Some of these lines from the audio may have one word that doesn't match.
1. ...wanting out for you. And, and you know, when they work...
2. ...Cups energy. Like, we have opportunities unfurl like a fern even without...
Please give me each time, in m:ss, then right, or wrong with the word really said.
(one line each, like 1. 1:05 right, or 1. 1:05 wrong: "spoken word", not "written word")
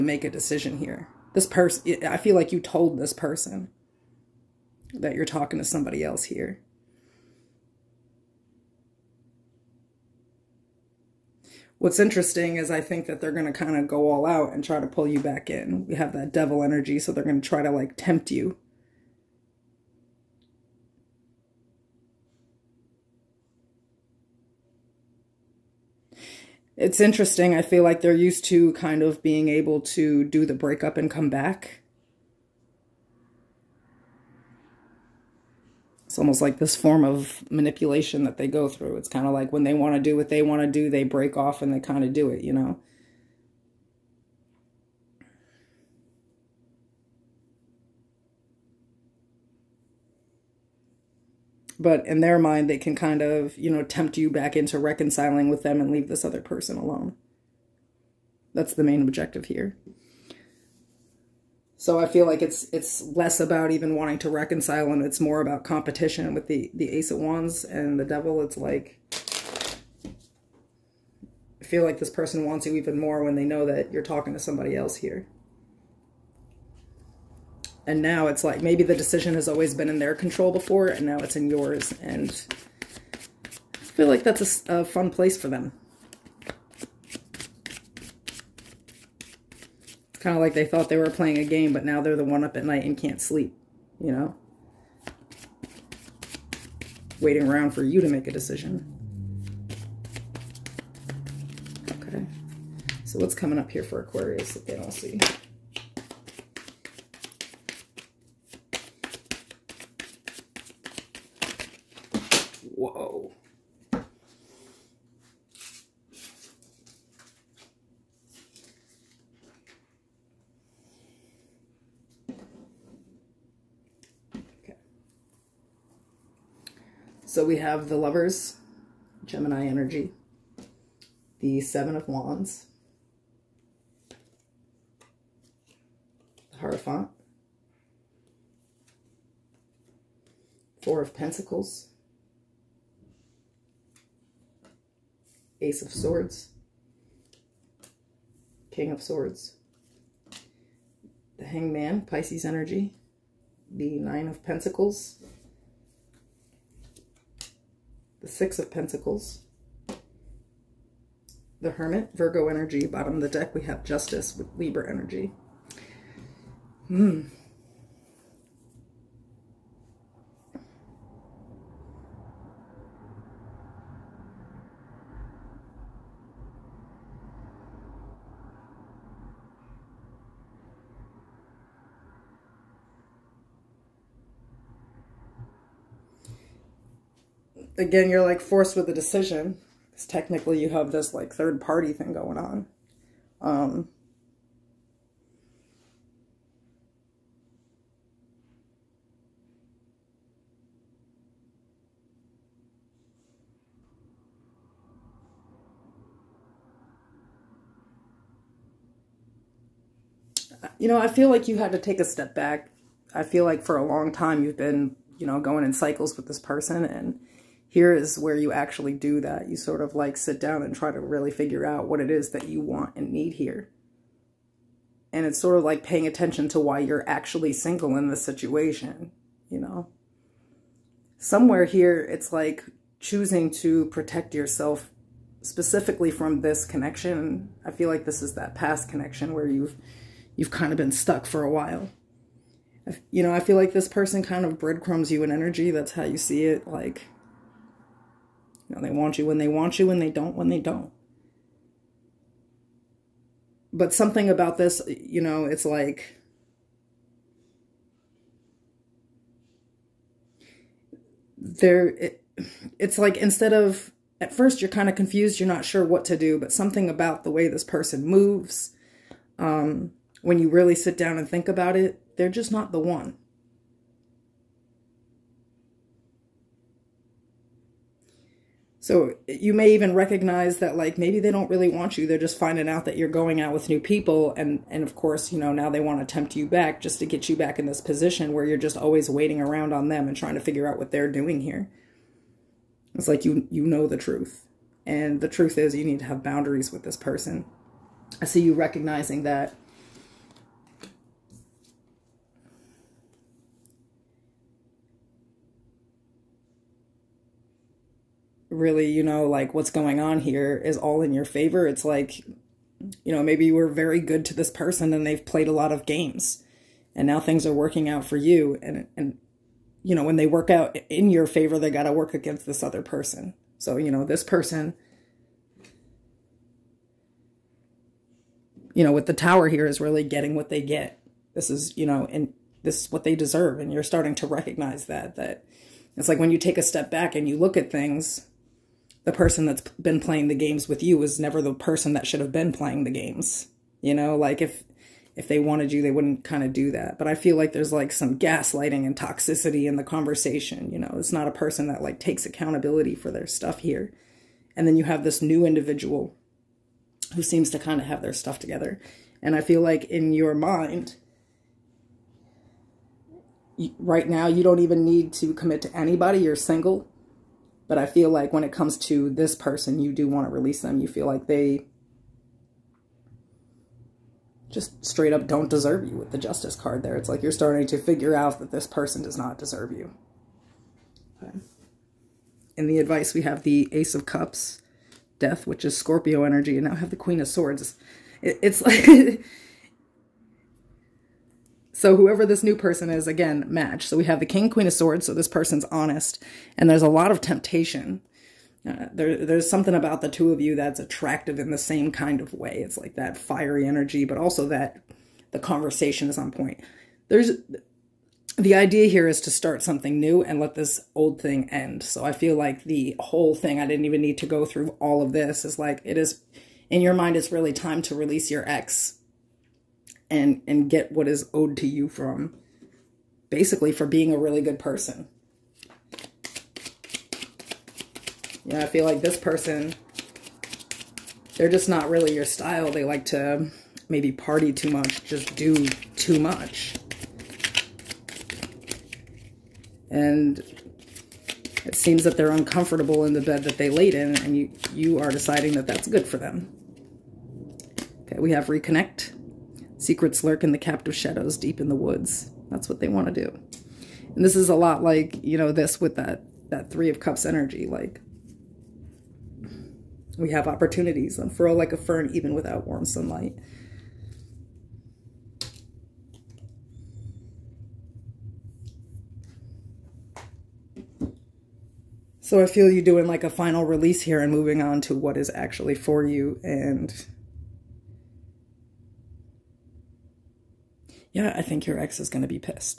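1. 5:17 wrong: "working", not "wanting"
2. 7:36 right.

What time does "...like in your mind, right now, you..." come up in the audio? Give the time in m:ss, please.
5:59.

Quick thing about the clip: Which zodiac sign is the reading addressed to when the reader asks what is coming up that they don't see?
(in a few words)
Aquarius.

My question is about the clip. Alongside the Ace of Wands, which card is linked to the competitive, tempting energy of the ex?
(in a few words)
The Devil.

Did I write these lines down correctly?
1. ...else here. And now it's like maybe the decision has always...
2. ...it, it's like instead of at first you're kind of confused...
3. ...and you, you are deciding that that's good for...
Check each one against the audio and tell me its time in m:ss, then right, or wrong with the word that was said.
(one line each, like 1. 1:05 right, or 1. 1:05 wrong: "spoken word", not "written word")
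1. 1:14 right
2. 4:21 right
3. 7:24 right.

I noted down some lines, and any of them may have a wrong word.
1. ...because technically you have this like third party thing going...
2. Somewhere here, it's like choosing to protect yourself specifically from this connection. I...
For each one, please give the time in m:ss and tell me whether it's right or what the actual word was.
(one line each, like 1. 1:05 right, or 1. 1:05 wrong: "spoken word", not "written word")
1. 3:09 right
2. 3:51 right.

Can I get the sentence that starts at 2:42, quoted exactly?
Bottom of the deck, we have Justice with Libra energy.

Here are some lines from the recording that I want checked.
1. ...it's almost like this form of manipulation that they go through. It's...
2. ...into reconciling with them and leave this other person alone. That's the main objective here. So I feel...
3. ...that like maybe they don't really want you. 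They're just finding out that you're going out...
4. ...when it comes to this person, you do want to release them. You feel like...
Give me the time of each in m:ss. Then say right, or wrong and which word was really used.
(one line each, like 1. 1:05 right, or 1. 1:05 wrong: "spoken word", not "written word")
1. 0:36 right
2. 0:54 right
3. 4:40 right
4. 6:08 right.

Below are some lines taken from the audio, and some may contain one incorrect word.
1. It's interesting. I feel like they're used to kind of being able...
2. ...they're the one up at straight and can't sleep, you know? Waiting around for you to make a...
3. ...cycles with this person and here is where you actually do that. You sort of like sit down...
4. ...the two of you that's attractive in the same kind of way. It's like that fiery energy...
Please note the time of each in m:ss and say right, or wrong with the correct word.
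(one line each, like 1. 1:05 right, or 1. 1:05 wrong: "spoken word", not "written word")
1. 0:26 right
2. 1:32 wrong: "night", not "straight"
3. 3:35 right
4. 6:40 right.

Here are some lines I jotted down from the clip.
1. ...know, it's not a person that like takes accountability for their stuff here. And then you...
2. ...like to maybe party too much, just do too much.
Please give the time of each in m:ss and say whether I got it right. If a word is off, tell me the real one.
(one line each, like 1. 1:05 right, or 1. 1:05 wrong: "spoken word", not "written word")
1. 5:50 right
2. 7:12 right.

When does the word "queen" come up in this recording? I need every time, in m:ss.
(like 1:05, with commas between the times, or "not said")
6:26, 6:34.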